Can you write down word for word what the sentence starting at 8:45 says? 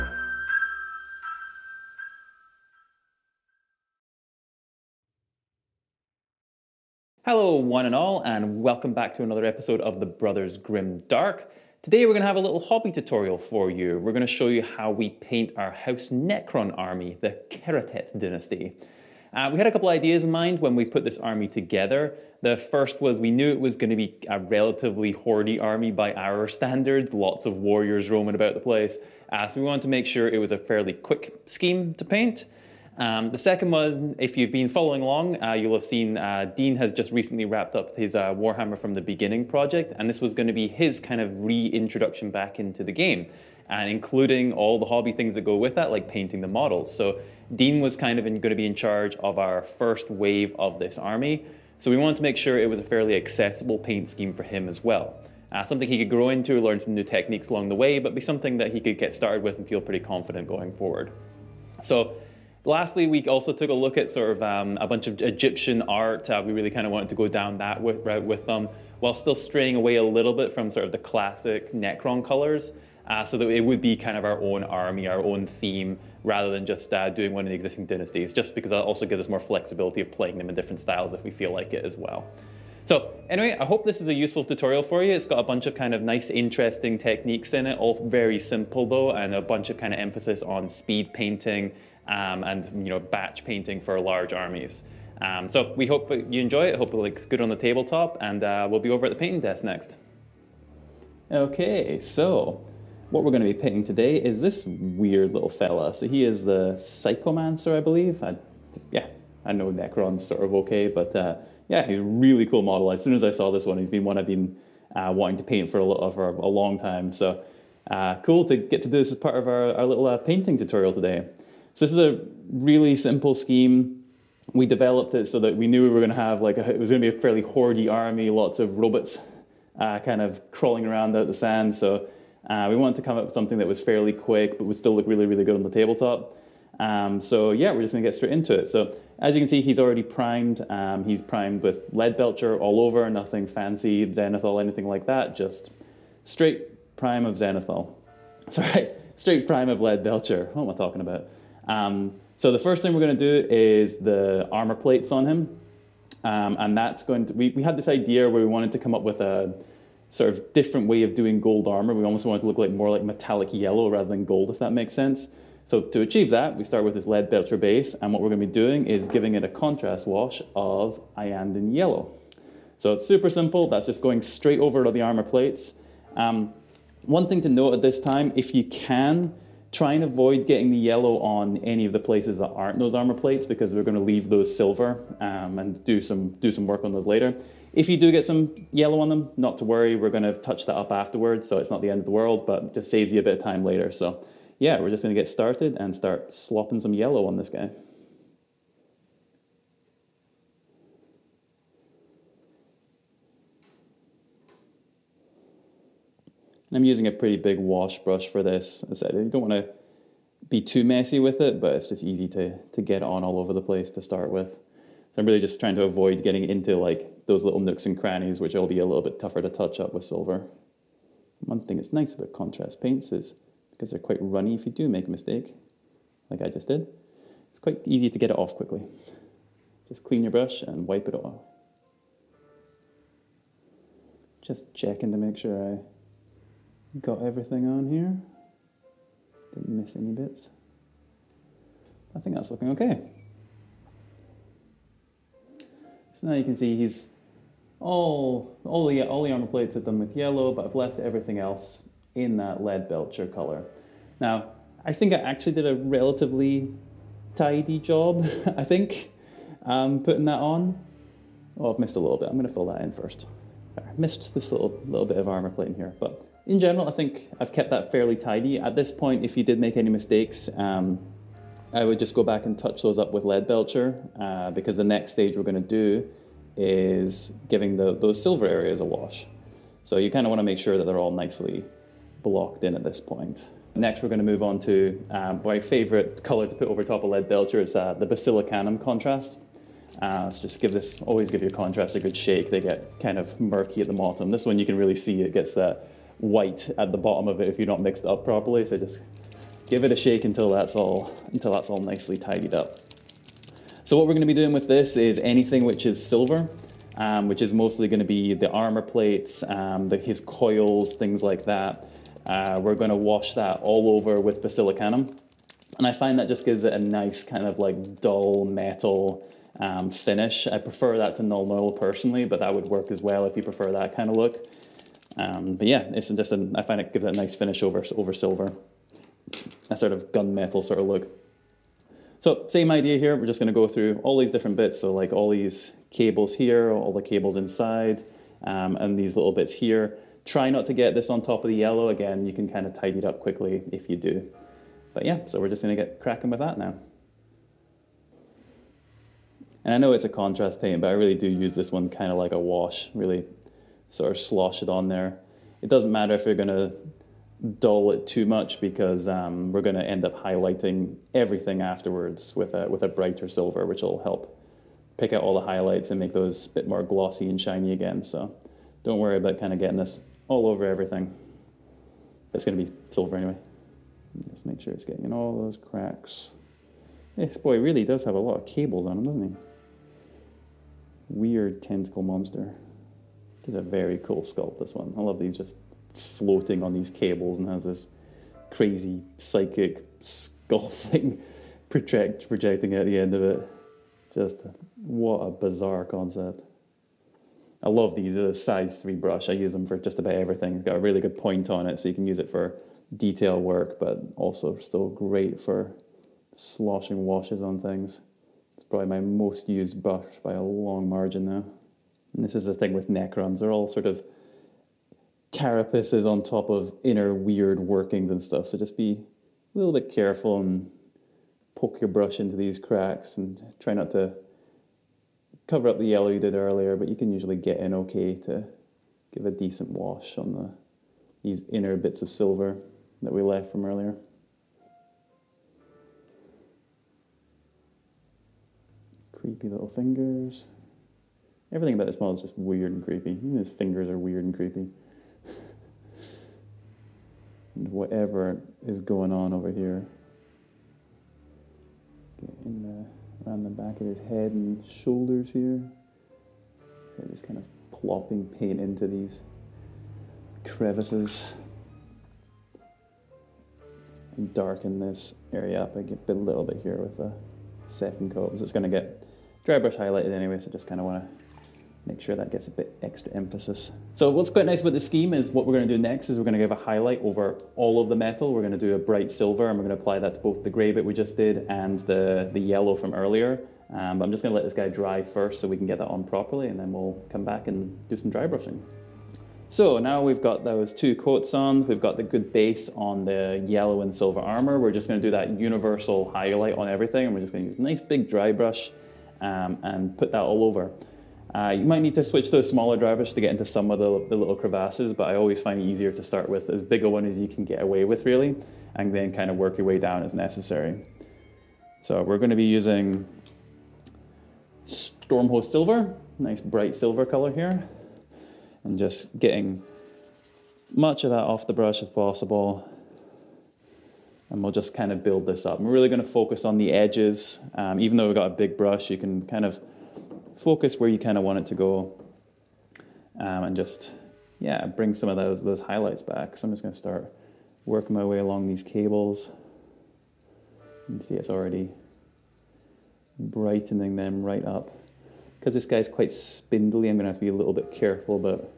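And we're really going to focus on the edges.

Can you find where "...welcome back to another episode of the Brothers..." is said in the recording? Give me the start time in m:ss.
0:08.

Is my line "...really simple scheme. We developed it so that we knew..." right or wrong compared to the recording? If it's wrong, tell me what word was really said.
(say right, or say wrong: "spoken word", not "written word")
right.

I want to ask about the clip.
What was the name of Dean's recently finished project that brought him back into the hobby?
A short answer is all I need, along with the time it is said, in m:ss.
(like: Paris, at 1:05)
Warhammer from the Beginning, at 0:38.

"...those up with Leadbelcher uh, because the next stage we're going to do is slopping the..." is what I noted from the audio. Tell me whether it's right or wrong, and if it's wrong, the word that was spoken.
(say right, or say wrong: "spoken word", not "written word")
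wrong: "giving", not "slopping".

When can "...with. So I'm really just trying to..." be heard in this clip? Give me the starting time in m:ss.
3:34.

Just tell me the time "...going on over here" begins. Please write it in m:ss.
7:28.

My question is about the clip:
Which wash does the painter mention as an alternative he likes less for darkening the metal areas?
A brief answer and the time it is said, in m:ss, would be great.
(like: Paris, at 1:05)
Nuln Oil, at 5:21.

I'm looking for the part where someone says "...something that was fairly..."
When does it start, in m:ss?
2:13.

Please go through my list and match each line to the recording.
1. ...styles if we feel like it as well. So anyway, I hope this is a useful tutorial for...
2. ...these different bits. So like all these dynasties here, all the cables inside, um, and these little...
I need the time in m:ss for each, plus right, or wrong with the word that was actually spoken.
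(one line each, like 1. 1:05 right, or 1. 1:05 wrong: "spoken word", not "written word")
1. 1:20 right
2. 5:34 wrong: "cables", not "dynasties".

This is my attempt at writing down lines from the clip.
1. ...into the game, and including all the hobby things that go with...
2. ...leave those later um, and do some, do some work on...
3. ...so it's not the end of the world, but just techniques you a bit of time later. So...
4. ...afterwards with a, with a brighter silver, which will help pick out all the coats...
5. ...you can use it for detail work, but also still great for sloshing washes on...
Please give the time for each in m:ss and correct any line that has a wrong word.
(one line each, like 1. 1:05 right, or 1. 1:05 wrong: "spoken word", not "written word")
1. 0:42 right
2. 3:03 wrong: "silver", not "later"
3. 3:11 wrong: "saves", not "techniques"
4. 6:01 wrong: "highlights", not "coats"
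5. 6:41 right.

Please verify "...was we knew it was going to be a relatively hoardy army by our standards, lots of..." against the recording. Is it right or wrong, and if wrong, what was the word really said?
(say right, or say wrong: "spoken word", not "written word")
right.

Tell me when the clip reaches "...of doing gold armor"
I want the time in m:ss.
2:41.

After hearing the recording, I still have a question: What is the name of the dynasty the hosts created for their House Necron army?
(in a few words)
Kehratet.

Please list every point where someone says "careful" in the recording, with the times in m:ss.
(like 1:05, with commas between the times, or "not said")
6:59, 9:07.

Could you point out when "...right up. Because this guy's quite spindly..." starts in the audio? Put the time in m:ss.
9:04.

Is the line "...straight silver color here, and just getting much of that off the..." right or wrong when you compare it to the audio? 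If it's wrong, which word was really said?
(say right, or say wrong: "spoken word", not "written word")
wrong: "bright", not "straight".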